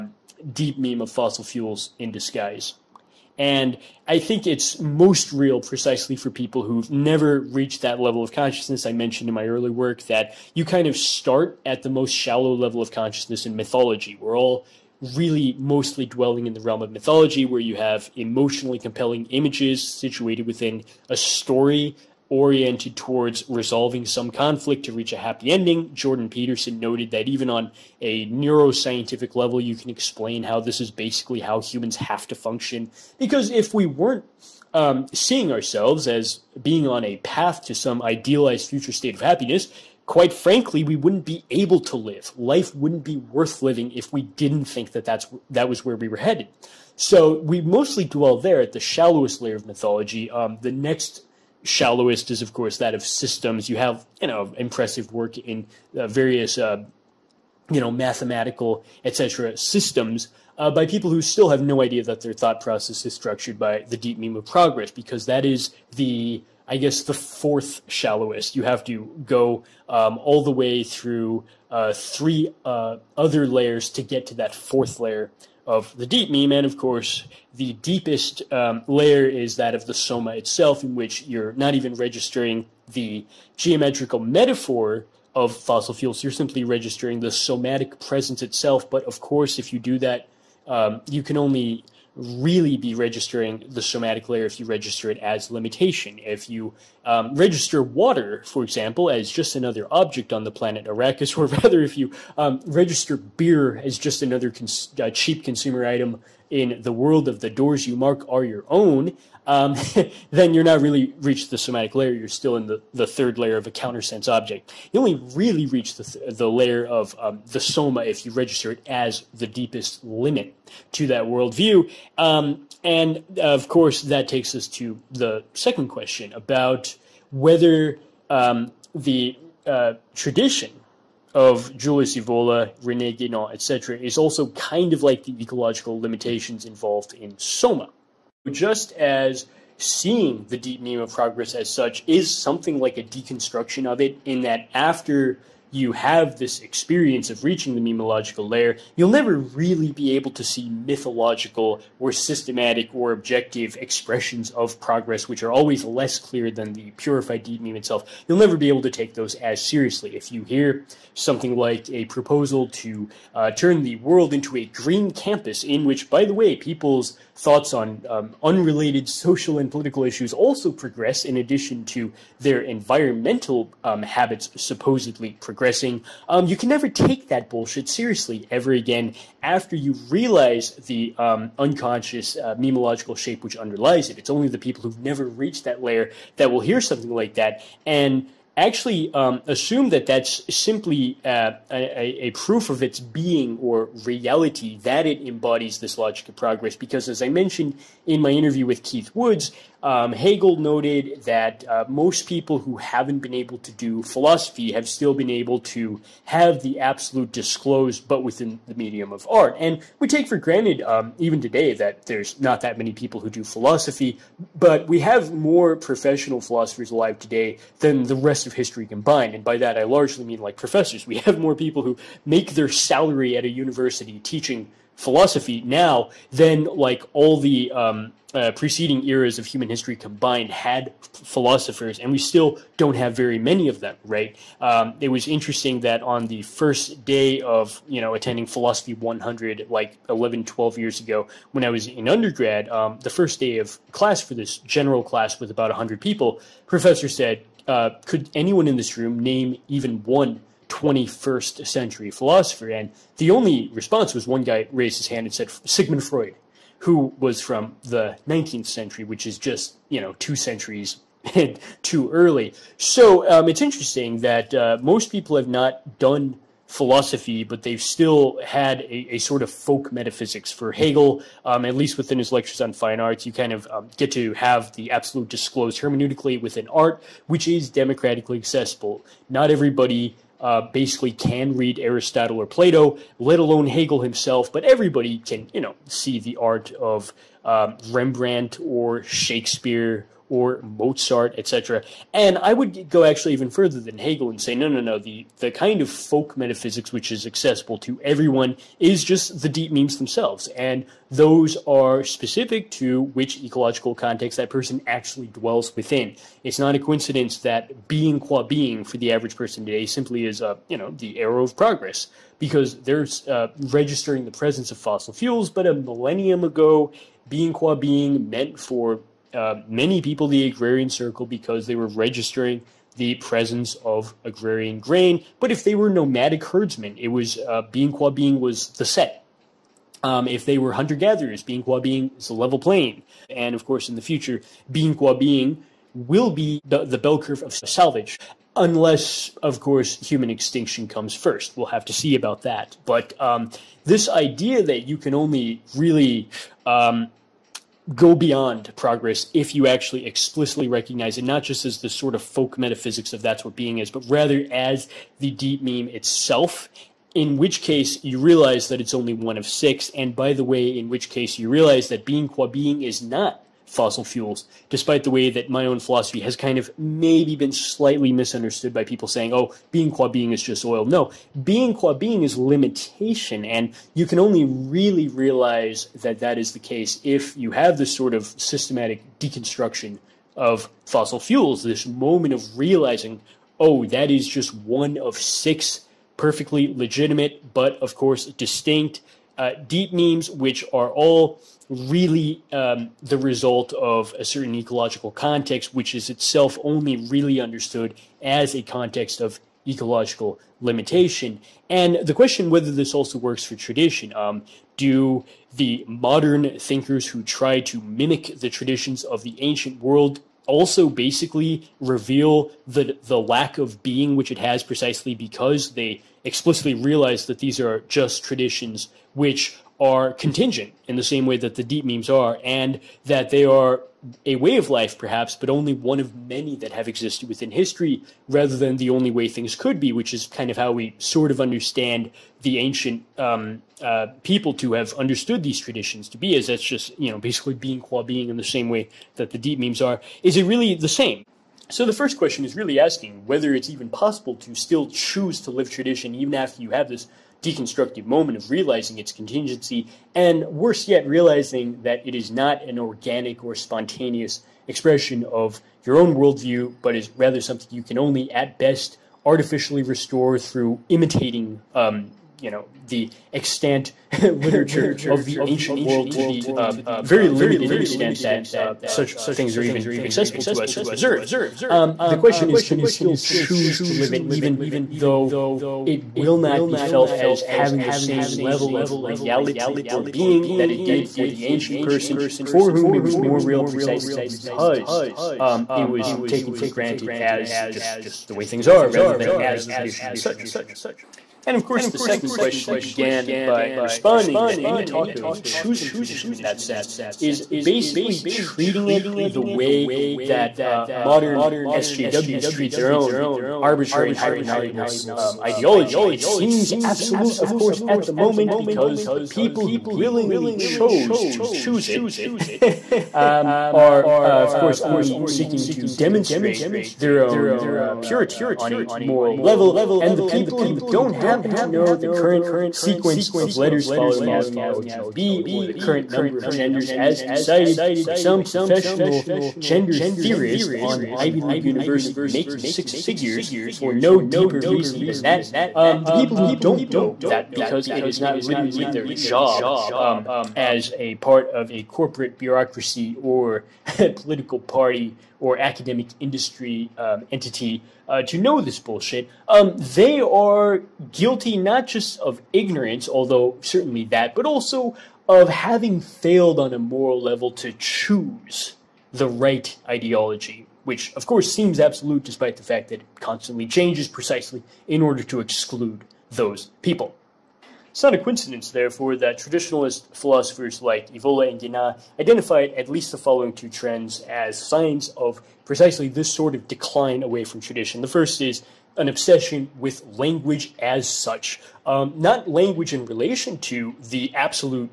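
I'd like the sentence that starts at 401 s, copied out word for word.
And the question whether this also works for tradition.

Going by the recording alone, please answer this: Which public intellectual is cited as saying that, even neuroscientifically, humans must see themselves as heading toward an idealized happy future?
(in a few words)
Jordan Peterson.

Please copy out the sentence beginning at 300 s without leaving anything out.
And those are specific to which ecological context that person actually dwells within.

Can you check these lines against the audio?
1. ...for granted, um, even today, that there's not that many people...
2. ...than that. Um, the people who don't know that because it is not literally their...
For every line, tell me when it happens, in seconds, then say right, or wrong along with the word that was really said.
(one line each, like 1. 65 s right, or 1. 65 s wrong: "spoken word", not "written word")
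1. 210 s right
2. 535 s right.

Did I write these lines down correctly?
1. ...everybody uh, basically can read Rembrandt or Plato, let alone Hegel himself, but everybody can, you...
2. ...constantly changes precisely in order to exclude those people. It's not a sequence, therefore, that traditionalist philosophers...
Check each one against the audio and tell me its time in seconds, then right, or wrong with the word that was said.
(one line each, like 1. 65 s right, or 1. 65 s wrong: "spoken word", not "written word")
1. 279 s wrong: "Aristotle", not "Rembrandt"
2. 563 s wrong: "coincidence", not "sequence".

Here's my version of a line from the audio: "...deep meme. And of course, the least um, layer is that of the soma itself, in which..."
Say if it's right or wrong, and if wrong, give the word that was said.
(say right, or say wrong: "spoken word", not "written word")
wrong: "deepest", not "least".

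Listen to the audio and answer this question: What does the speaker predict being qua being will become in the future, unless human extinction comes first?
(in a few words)
the bell curve of salvage.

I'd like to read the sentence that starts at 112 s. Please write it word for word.
You're still in the, the third layer of a countersense object.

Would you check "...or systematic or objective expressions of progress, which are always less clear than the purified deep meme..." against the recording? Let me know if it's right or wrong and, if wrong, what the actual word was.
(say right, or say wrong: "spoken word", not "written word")
right.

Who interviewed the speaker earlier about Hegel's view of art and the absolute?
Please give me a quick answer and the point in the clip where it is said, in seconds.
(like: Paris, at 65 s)
Keith Woods, at 198 s.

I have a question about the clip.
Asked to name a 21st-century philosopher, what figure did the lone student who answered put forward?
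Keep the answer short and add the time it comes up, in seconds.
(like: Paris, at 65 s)
Sigmund Freud, at 255 s.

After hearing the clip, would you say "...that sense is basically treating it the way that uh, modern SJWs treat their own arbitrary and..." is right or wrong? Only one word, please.
right.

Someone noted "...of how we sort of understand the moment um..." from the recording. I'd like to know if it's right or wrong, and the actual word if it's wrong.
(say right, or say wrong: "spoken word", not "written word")
wrong: "ancient", not "moment".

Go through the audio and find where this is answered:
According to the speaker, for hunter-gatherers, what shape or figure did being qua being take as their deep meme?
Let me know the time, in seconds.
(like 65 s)
332 s.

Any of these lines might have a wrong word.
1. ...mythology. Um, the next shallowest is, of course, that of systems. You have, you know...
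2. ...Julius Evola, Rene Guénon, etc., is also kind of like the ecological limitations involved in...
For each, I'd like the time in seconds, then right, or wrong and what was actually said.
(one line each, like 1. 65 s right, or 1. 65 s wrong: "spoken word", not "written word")
1. 49 s right
2. 131 s right.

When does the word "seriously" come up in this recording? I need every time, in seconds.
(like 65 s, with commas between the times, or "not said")
159 s, 177 s.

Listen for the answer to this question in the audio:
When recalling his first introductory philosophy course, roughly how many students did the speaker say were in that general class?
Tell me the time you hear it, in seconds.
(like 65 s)
245 s.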